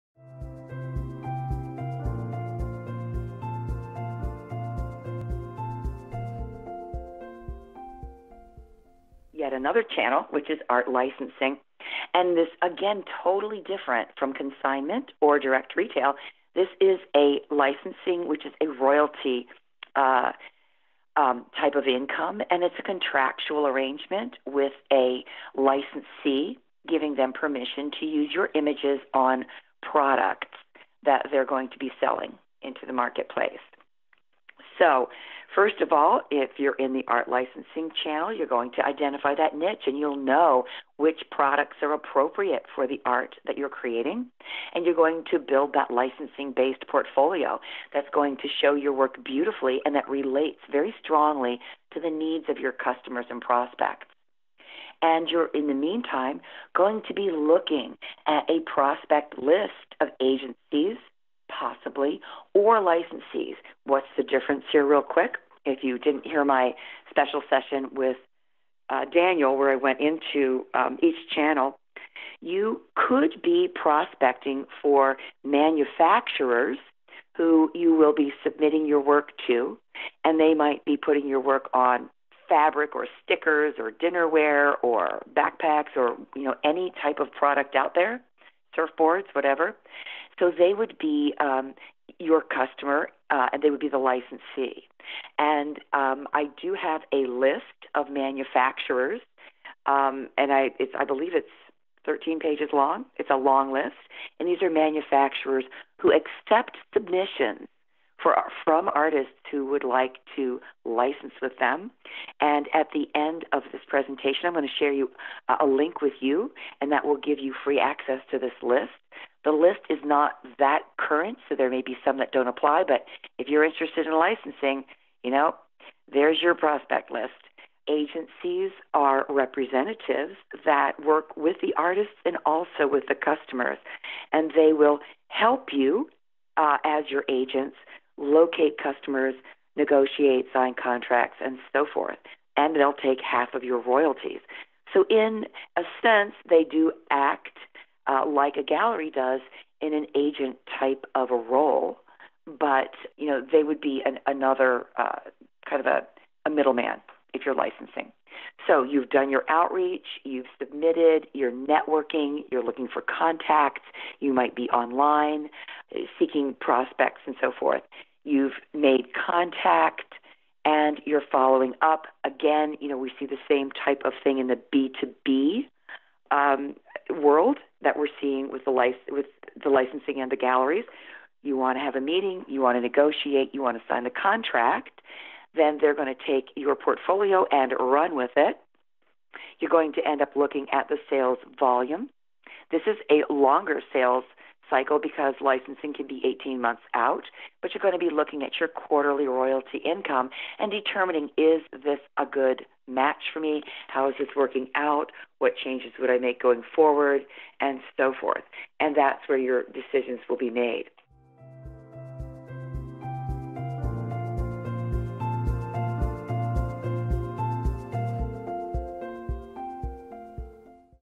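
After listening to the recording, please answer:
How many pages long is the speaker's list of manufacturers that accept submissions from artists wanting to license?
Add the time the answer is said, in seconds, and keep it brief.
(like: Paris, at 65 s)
13, at 102 s.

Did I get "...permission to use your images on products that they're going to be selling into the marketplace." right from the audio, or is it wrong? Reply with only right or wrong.
right.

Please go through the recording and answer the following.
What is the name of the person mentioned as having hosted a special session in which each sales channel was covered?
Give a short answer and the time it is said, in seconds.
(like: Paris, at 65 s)
Daniel, at 69 s.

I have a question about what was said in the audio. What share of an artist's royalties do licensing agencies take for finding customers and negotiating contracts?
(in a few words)
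Half.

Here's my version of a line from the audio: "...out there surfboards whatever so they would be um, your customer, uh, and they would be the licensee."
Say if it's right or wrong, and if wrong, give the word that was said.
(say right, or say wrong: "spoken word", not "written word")
right.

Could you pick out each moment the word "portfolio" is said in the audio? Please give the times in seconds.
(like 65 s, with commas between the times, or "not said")
46 s, 186 s.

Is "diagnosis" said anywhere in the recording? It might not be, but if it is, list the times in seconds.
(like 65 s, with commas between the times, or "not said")
not said.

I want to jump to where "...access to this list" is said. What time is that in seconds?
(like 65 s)
117 s.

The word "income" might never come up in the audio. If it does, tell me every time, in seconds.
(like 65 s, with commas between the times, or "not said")
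21 s, 199 s.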